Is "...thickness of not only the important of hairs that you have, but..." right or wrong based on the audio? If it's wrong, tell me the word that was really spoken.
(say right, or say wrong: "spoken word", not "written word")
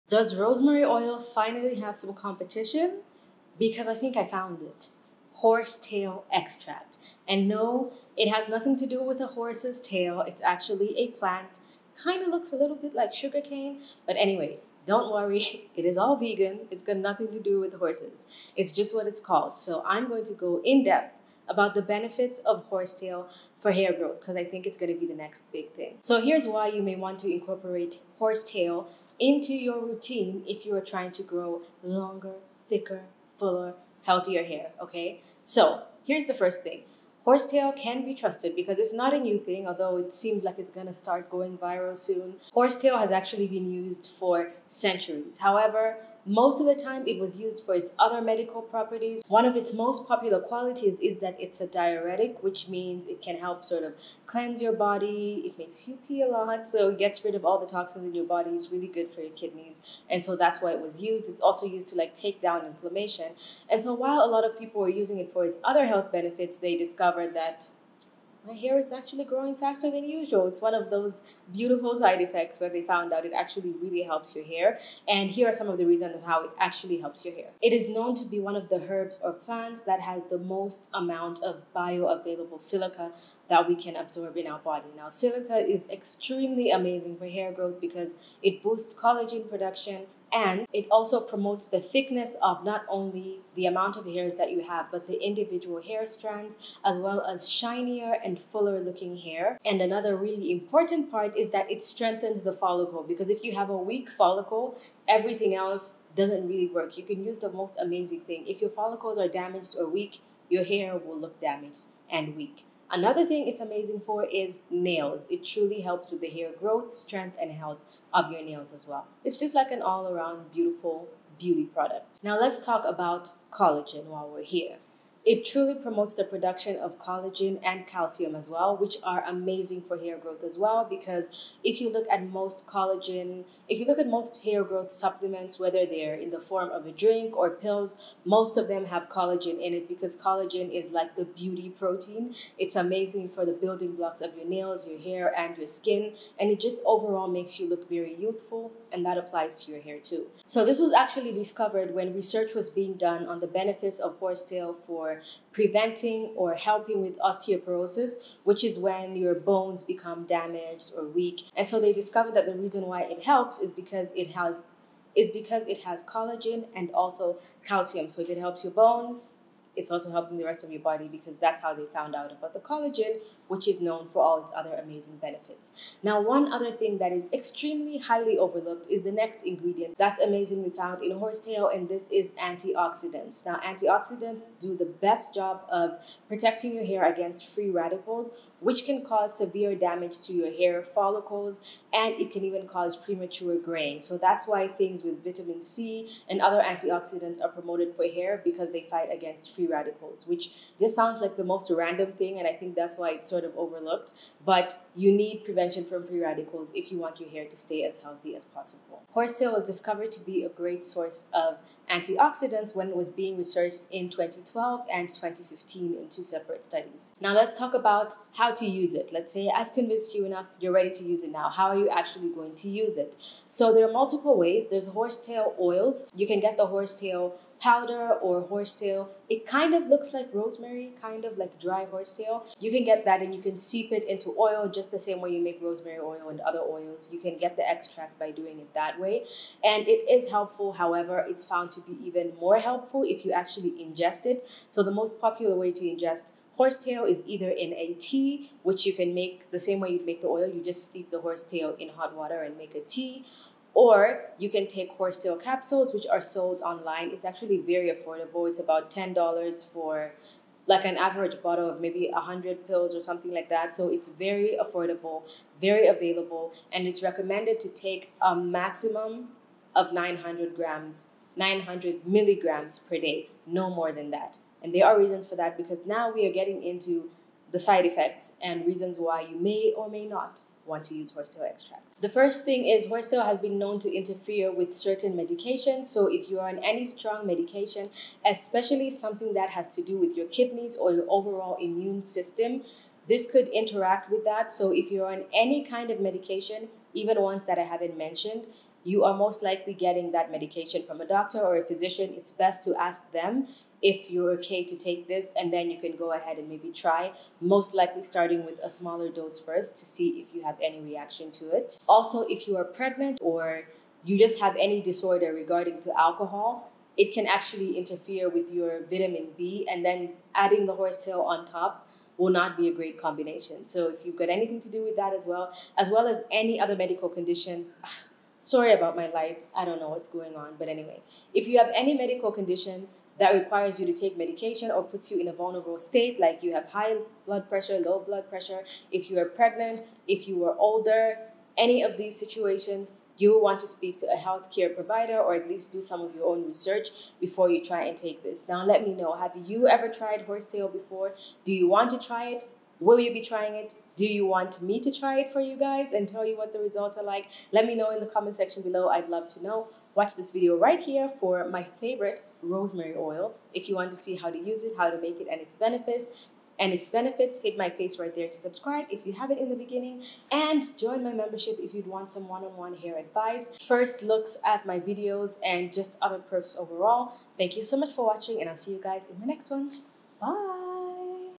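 wrong: "amount", not "important".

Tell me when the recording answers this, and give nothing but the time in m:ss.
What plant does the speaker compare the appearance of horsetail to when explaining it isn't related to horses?
0:13.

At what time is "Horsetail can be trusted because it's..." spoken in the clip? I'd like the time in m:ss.
0:37.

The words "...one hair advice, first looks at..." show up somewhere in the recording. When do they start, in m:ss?
6:12.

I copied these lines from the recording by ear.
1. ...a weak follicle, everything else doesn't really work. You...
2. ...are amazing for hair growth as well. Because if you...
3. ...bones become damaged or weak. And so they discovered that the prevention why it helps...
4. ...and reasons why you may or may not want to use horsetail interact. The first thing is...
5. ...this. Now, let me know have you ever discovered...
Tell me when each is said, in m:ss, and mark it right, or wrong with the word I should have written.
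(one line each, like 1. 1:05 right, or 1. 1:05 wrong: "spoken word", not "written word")
1. 1:43 right
2. 2:09 right
3. 2:39 wrong: "reason", not "prevention"
4. 4:38 wrong: "extract", not "interact"
5. 5:48 wrong: "tried", not "discovered".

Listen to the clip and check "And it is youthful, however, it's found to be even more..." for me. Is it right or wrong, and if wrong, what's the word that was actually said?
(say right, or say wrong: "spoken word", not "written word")
wrong: "helpful", not "youthful".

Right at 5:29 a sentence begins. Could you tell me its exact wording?
I don't know what's going on.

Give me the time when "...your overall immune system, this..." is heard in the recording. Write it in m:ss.
4:50.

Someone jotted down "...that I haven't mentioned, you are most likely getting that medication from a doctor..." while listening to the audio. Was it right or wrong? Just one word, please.
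right.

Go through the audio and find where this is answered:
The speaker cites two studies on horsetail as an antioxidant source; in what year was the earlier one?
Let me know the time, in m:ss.
3:34.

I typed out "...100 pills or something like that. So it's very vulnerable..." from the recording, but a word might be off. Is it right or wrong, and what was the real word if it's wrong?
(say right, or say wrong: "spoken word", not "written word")
wrong: "affordable", not "vulnerable".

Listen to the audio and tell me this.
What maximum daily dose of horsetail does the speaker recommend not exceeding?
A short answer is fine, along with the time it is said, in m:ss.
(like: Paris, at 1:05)
900 milligrams, at 4:31.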